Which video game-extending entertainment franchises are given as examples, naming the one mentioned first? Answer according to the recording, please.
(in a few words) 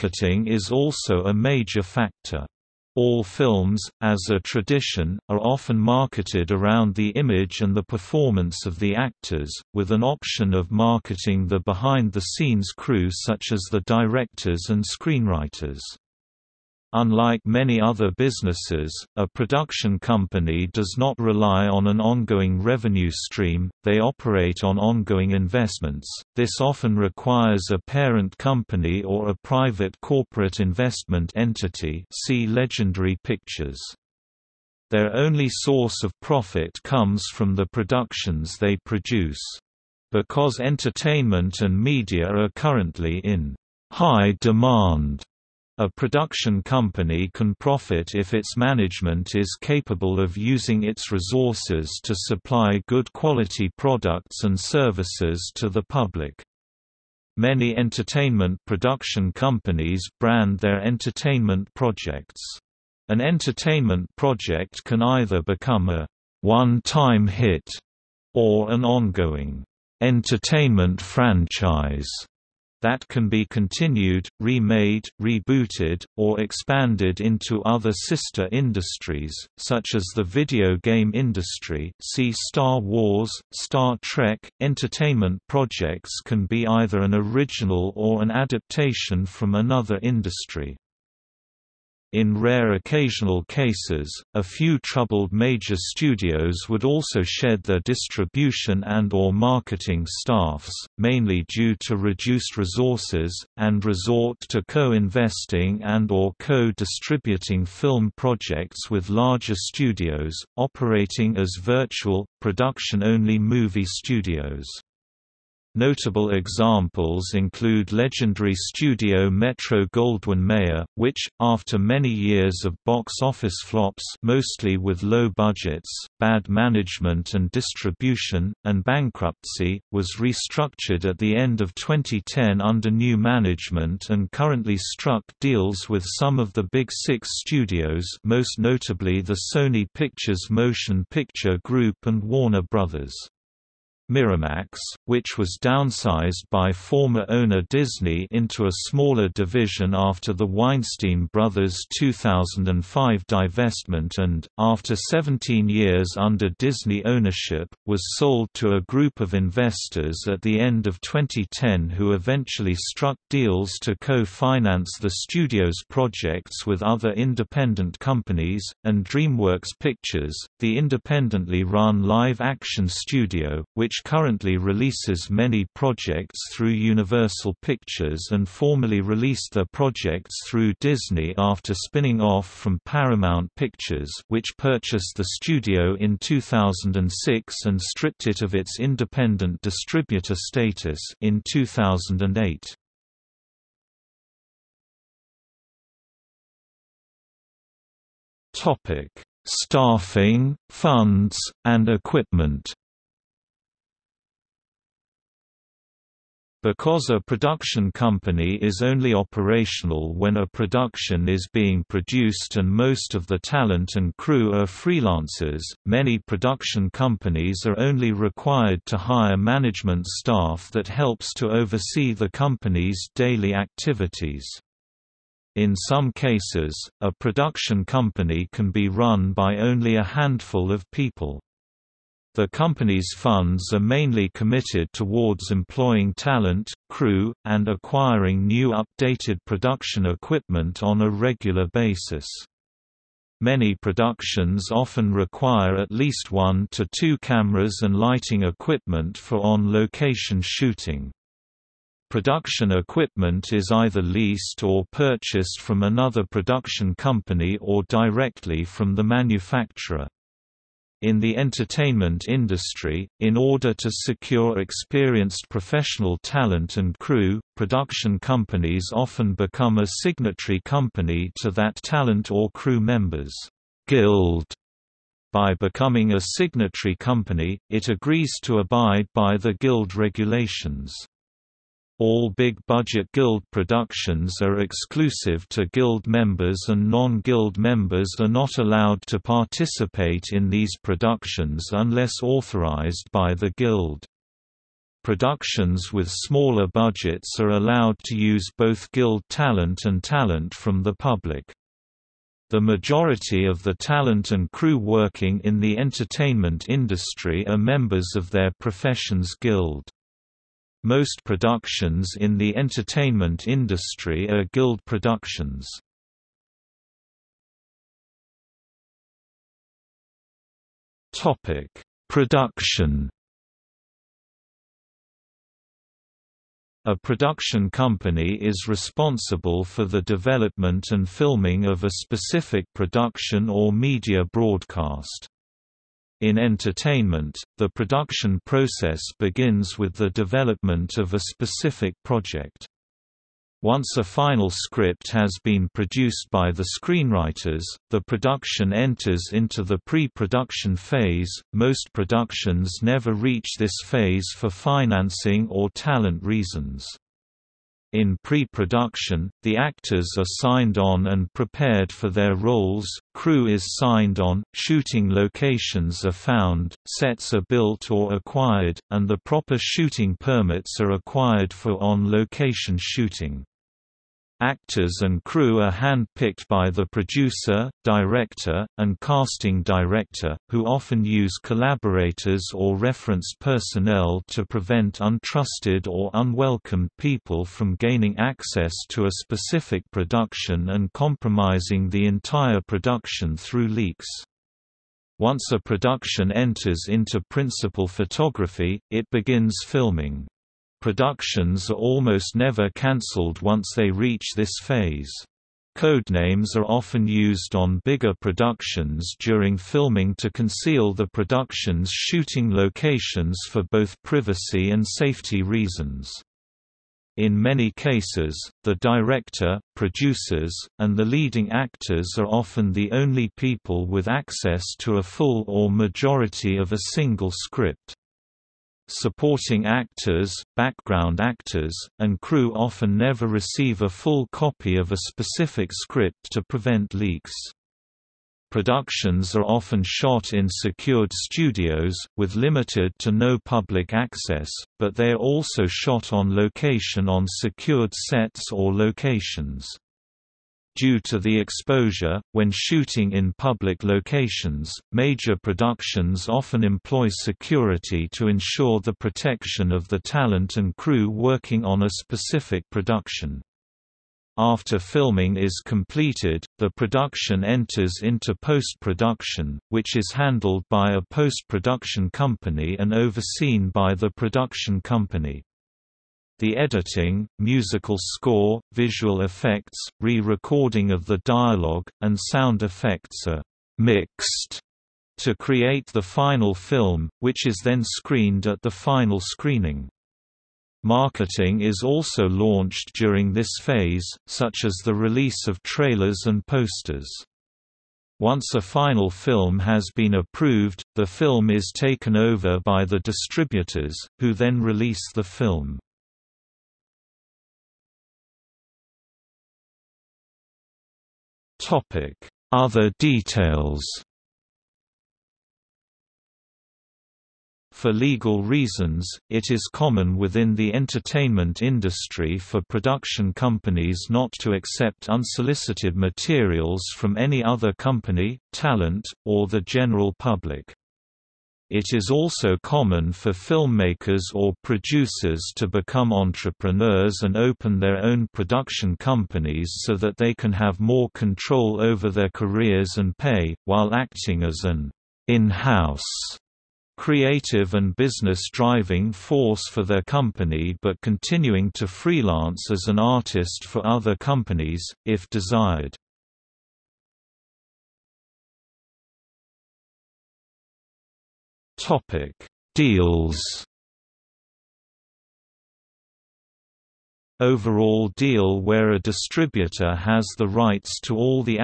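Star Wars.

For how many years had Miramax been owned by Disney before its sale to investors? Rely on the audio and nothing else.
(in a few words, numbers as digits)
17.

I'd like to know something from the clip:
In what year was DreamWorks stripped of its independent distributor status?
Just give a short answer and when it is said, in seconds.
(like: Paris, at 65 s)
2008, at 191 s.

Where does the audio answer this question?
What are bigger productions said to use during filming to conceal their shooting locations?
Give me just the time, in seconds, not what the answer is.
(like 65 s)
405 s.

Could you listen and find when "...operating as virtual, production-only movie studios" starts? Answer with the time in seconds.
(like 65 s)
110 s.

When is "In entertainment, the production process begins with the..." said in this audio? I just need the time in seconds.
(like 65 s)
336 s.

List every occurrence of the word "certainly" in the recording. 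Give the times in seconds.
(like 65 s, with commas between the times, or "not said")
not said.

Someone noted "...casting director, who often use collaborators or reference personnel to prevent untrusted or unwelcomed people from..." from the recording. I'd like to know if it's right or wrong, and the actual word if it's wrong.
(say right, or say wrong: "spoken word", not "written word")
right.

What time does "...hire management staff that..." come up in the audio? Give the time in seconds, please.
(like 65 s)
218 s.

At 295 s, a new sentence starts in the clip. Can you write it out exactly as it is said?
Productions with smaller budgets are allowed to use both Guild talent and talent from the public.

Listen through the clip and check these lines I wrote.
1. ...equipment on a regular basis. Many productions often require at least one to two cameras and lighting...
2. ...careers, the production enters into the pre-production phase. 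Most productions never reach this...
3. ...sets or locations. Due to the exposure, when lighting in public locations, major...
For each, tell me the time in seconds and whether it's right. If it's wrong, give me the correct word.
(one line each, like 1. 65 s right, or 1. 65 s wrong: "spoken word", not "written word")
1. 240 s right
2. 346 s wrong: "screenwriters", not "careers"
3. 447 s wrong: "shooting", not "lighting".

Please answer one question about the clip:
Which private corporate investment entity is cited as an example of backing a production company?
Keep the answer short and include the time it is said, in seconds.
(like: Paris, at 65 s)
Legendary Pictures, at 32 s.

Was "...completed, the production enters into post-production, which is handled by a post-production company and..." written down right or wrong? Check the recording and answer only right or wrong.
right.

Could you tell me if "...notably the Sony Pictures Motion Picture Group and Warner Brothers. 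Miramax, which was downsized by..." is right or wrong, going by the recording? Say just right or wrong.
right.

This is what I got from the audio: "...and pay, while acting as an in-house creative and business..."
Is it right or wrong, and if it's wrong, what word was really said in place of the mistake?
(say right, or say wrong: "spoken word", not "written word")
right.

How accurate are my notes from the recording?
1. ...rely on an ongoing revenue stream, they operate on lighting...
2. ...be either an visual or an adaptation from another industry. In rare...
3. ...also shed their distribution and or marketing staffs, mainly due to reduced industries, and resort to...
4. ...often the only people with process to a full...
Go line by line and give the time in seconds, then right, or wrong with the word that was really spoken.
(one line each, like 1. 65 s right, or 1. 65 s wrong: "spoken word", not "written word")
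1. 21 s wrong: "ongoing", not "lighting"
2. 86 s wrong: "original", not "visual"
3. 96 s wrong: "resources", not "industries"
4. 422 s wrong: "access", not "process".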